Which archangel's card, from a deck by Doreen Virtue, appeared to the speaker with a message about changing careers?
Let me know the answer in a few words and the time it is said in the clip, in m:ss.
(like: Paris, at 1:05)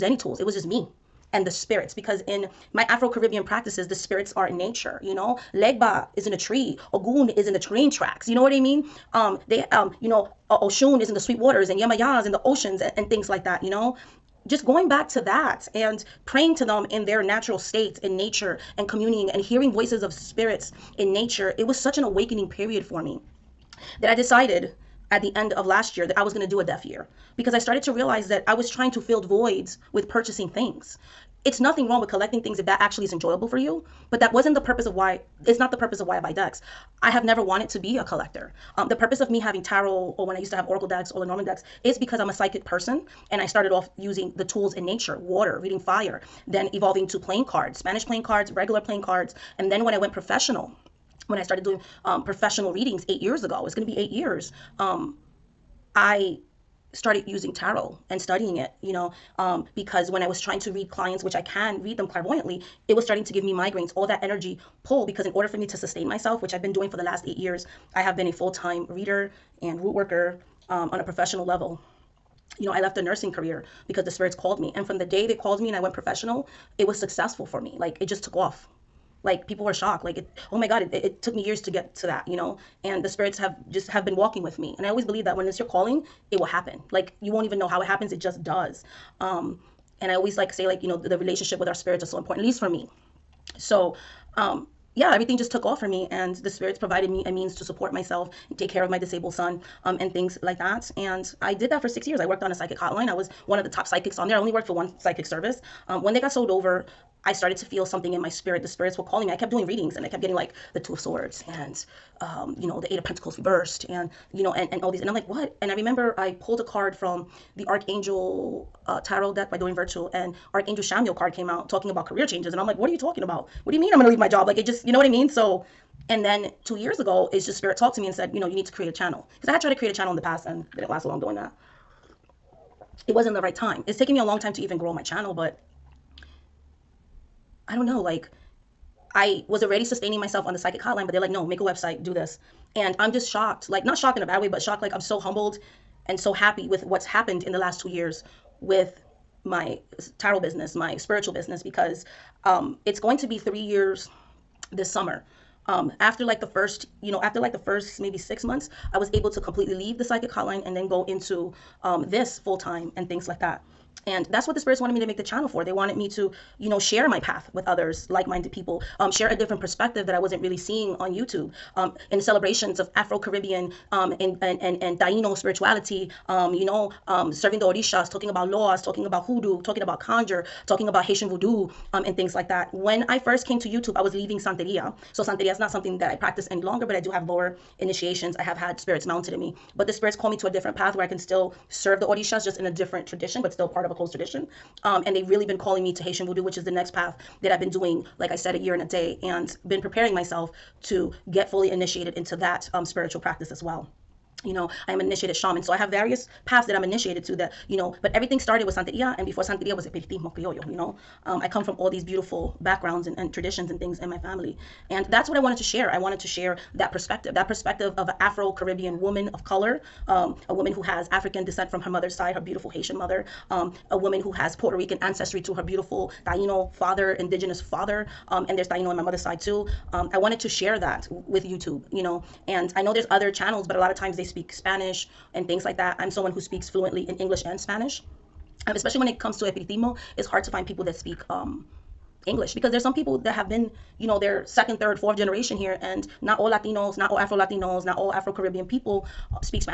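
Chamuel, at 2:00.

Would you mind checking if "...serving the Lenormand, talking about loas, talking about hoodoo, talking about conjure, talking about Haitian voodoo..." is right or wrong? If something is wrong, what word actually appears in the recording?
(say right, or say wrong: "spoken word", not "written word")
wrong: "Orishas", not "Lenormand".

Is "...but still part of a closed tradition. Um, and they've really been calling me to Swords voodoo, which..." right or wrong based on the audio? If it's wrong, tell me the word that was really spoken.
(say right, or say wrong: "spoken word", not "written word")
wrong: "Haitian", not "Swords".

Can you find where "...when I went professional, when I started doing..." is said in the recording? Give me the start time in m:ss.
0:49.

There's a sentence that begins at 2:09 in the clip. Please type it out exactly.
Because I had tried to create a channel in the past and didn't last long doing that.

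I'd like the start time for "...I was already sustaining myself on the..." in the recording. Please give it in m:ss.
2:19.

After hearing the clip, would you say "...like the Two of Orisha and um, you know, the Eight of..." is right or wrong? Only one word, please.
wrong.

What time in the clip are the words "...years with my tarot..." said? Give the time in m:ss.
2:27.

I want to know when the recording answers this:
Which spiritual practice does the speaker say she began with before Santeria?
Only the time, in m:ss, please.
3:29.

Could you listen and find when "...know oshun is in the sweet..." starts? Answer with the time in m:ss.
0:10.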